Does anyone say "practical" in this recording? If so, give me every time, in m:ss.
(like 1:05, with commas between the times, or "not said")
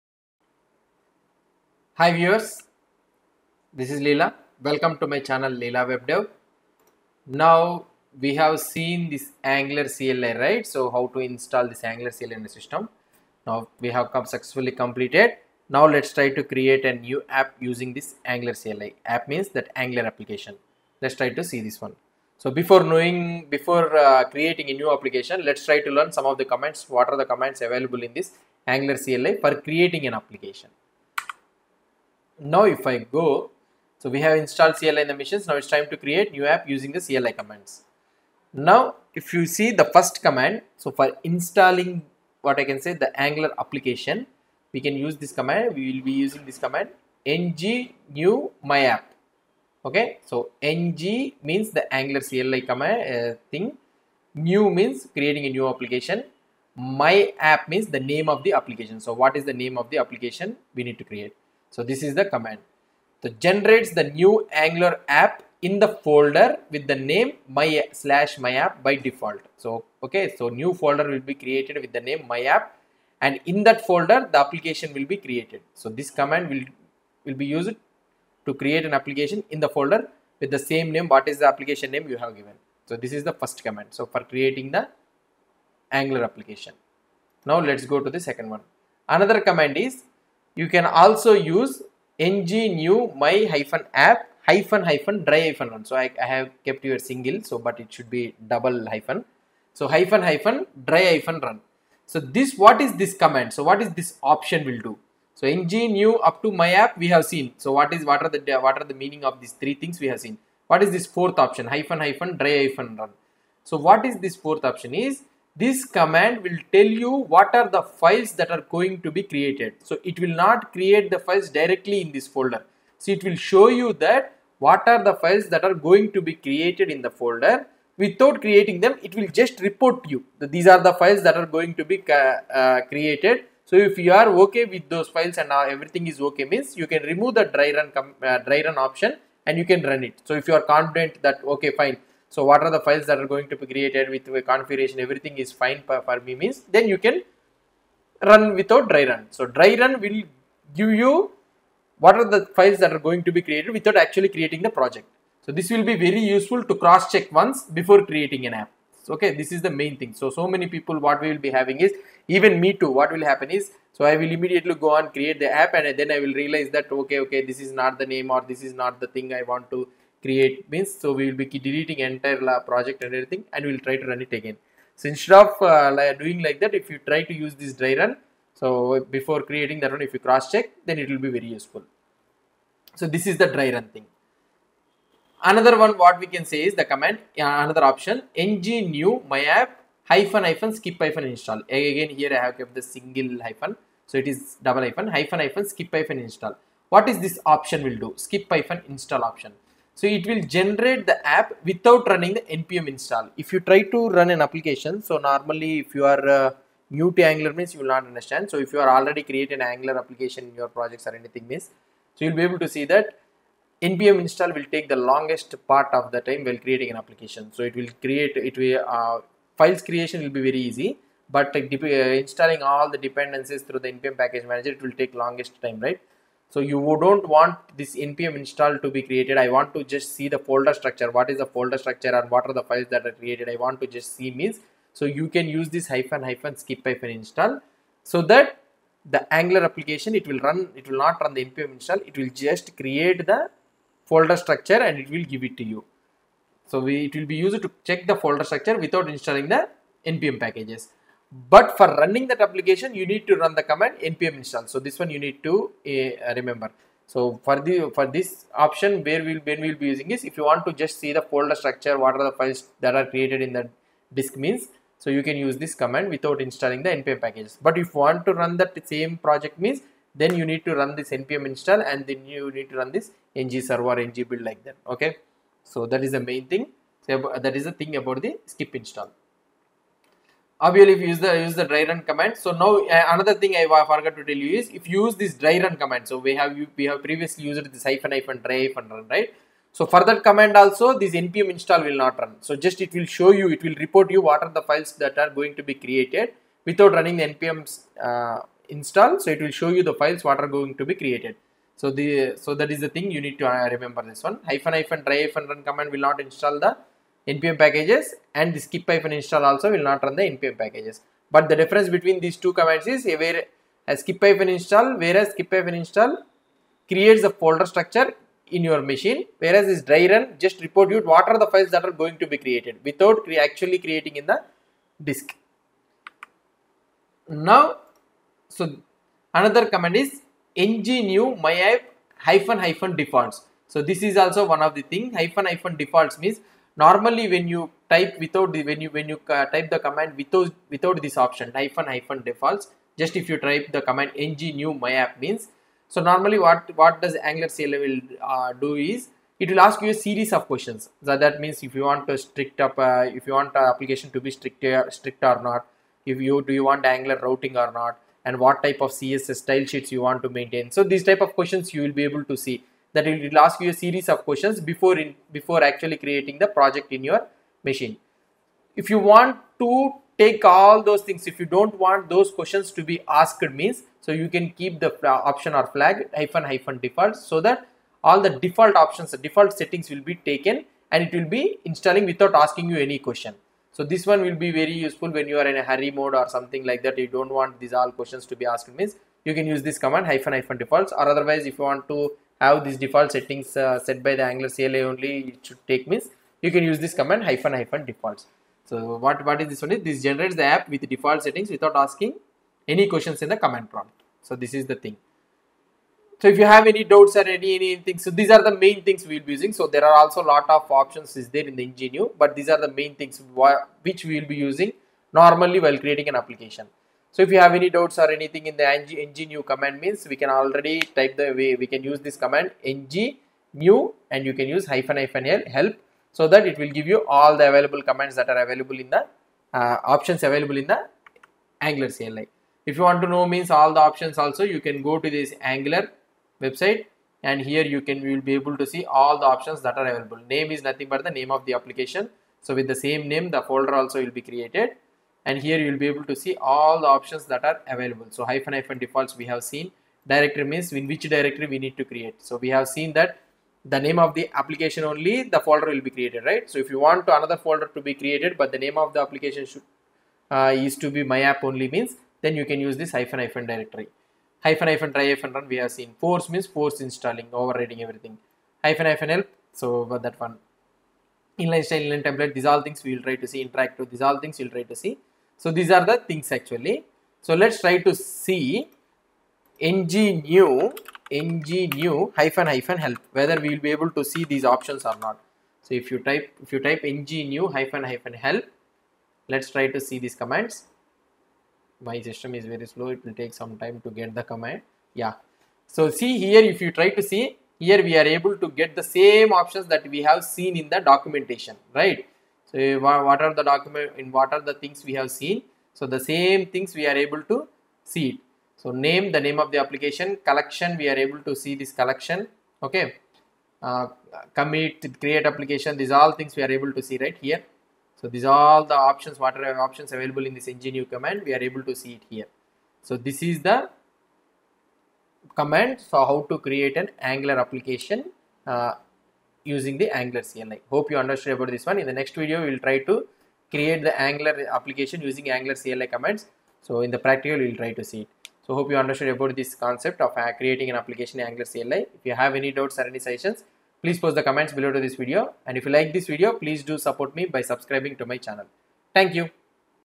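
8:56.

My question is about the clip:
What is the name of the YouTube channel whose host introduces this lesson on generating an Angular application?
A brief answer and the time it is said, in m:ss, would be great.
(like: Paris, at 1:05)
Leela Web Dev, at 0:05.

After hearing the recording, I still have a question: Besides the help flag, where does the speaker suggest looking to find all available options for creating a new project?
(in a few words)
Angular website.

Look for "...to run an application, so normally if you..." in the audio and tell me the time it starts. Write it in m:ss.
3:23.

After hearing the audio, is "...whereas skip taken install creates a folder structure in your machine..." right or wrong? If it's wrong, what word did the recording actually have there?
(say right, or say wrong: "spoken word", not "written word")
wrong: "hyphen", not "taken".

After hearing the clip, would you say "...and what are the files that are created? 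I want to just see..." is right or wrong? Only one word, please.
right.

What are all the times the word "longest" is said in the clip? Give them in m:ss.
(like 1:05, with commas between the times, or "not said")
3:35, 3:45.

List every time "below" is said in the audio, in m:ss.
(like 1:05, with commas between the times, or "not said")
9:04.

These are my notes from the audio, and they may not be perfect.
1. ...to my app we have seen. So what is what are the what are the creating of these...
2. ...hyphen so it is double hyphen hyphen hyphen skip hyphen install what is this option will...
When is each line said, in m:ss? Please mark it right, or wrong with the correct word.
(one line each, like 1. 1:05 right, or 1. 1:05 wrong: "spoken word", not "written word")
1. 1:46 wrong: "meaning", not "creating"
2. 3:13 right.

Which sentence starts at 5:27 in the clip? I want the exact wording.
Now, so another command is new myapp hyphen hyphen defaults.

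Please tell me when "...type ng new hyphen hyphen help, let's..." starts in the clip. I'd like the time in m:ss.
8:06.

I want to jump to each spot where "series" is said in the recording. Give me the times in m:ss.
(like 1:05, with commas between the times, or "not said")
5:49, 6:03.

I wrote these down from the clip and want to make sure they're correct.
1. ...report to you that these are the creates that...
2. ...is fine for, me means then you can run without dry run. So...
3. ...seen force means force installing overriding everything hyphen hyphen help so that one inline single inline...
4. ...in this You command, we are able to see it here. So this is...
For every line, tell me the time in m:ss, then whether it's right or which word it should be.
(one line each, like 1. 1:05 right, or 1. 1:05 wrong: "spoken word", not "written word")
1. 2:09 wrong: "files", not "creates"
2. 2:25 right
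3. 7:45 wrong: "style", not "single"
4. 8:40 right.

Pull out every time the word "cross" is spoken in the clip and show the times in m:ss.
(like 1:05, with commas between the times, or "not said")
2:36, 3:00.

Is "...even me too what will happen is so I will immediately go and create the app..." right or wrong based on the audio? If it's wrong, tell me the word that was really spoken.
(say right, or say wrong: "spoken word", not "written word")
right.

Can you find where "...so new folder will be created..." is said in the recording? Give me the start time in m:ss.
1:10.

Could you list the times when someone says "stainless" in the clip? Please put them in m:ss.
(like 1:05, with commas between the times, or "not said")
not said.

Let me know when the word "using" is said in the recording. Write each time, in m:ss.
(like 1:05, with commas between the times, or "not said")
0:17, 0:36, 0:46, 4:19, 6:49, 6:54, 8:49, 8:55.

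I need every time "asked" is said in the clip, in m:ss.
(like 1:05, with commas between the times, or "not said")
6:13, 6:28.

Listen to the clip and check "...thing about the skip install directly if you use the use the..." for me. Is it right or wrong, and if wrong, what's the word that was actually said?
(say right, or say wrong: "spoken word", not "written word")
wrong: "obviously", not "directly".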